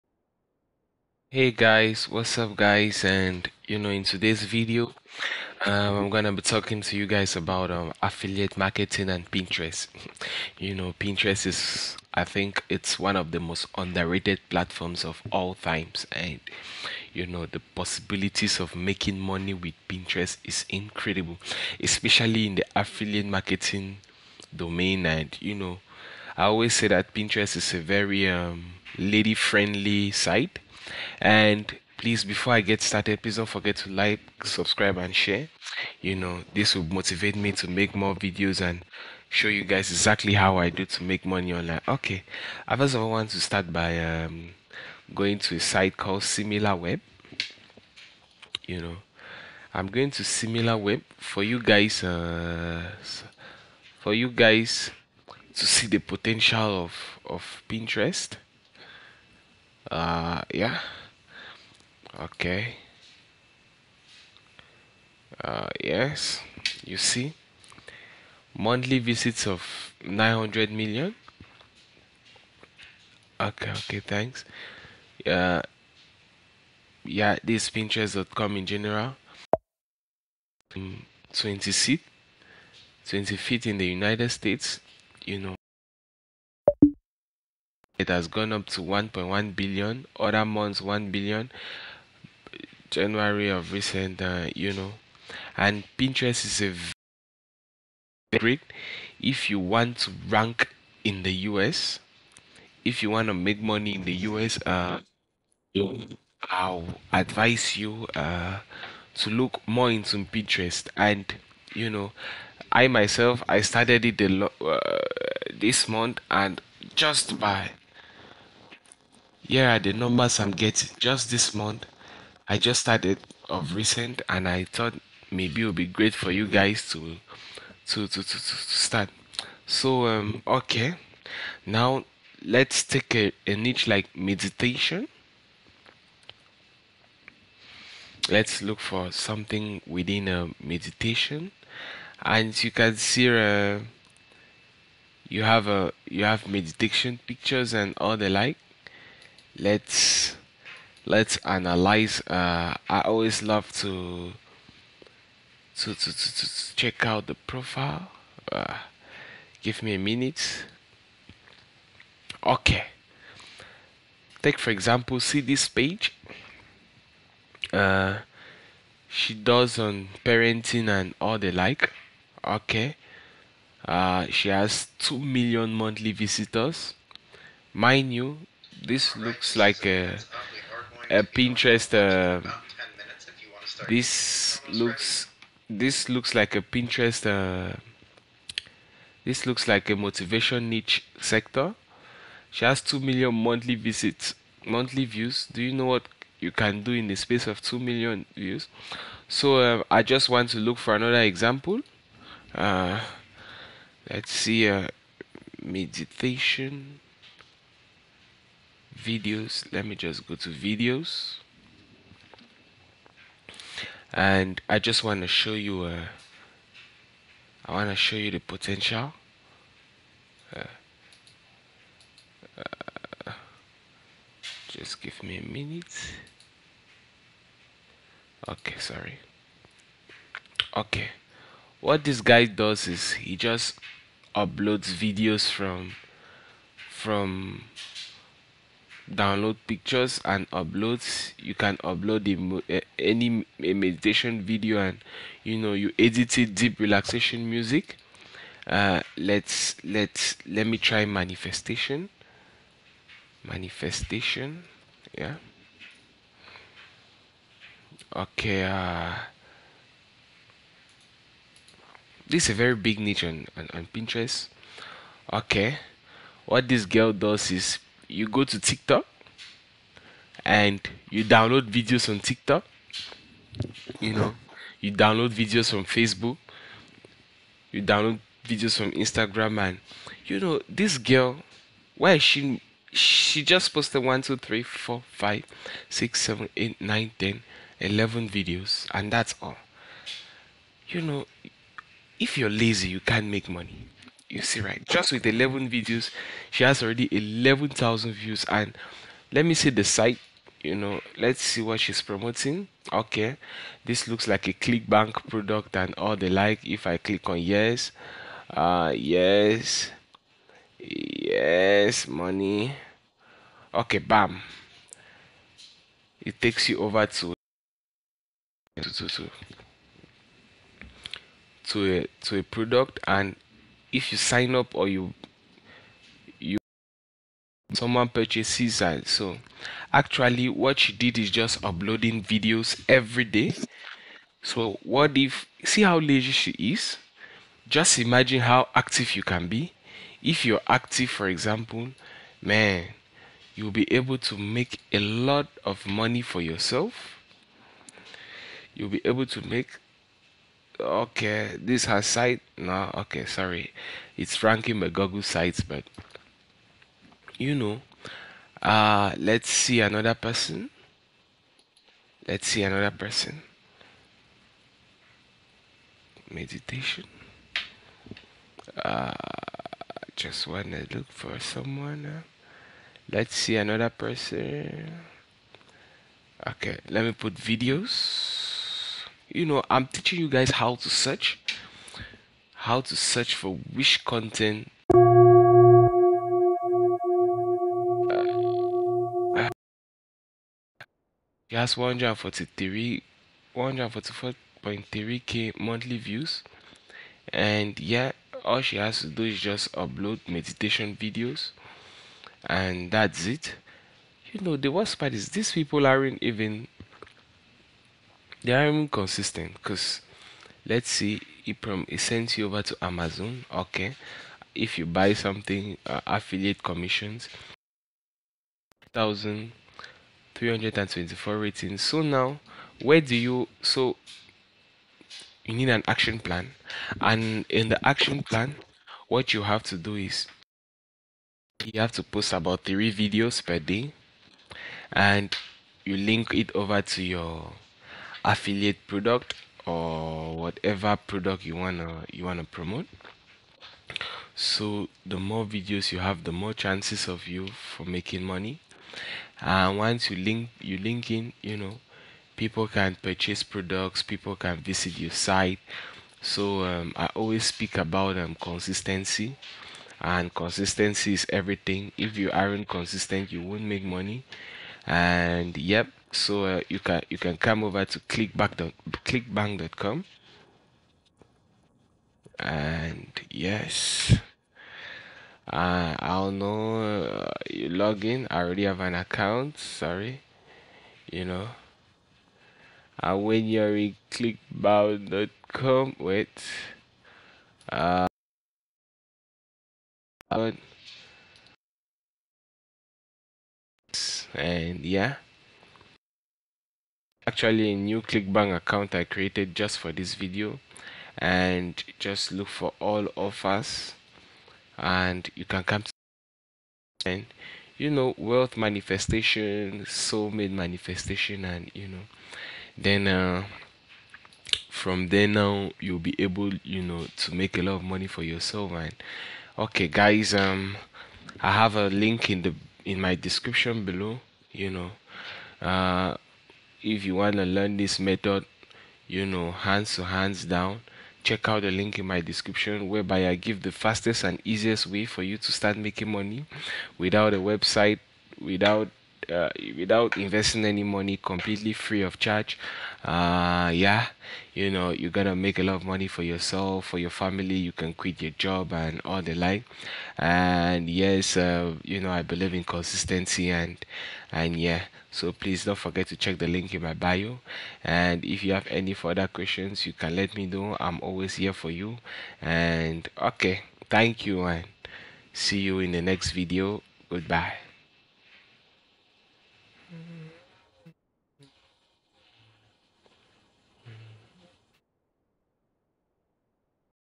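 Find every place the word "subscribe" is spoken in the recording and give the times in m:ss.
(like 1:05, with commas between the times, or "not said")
0:34.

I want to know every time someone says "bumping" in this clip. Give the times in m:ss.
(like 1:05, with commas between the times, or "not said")
not said.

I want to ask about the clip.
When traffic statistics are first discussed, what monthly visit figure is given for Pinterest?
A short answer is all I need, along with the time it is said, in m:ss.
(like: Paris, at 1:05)
900 million, at 1:10.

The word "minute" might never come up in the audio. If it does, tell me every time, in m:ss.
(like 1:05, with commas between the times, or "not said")
2:39, 3:45.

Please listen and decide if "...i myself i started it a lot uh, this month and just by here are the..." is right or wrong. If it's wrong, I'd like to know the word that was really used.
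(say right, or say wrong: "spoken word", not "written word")
right.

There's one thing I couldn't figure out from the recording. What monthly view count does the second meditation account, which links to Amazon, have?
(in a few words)
144.3k.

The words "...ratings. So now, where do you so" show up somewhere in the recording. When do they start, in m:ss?
7:01.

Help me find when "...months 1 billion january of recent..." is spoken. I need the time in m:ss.
1:30.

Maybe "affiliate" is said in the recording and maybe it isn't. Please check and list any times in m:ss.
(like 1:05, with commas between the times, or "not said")
0:08, 0:22, 6:56, 7:18.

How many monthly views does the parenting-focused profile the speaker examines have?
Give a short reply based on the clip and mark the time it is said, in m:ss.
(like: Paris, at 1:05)
2 million, at 2:54.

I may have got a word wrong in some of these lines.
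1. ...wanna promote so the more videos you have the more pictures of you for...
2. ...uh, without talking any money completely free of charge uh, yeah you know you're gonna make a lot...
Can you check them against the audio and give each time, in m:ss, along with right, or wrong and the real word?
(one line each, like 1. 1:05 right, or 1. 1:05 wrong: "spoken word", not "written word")
1. 7:22 wrong: "chances", not "pictures"
2. 8:59 wrong: "investing", not "talking".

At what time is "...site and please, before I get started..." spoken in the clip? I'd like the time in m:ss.
0:30.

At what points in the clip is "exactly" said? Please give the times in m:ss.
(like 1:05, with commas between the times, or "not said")
0:39.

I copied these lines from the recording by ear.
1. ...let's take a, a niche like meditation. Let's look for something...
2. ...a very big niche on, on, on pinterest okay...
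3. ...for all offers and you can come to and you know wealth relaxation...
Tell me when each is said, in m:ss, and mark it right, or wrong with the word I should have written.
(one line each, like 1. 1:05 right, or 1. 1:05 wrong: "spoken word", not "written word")
1. 2:12 right
2. 4:22 right
3. 8:22 wrong: "manifestation", not "relaxation".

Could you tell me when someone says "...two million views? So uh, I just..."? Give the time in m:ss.
3:17.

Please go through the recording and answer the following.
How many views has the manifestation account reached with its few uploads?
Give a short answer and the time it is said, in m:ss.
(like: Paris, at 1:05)
11,000, at 4:57.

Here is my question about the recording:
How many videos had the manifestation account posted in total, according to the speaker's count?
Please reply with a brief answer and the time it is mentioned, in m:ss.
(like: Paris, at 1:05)
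11, at 4:47.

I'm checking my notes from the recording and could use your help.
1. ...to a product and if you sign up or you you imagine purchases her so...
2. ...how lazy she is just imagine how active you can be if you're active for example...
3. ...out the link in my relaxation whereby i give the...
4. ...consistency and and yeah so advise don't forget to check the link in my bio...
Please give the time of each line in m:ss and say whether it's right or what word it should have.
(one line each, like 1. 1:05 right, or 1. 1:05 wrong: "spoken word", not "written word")
1. 5:22 wrong: "someone", not "imagine"
2. 5:35 right
3. 8:51 wrong: "description", not "relaxation"
4. 9:12 wrong: "please", not "advise".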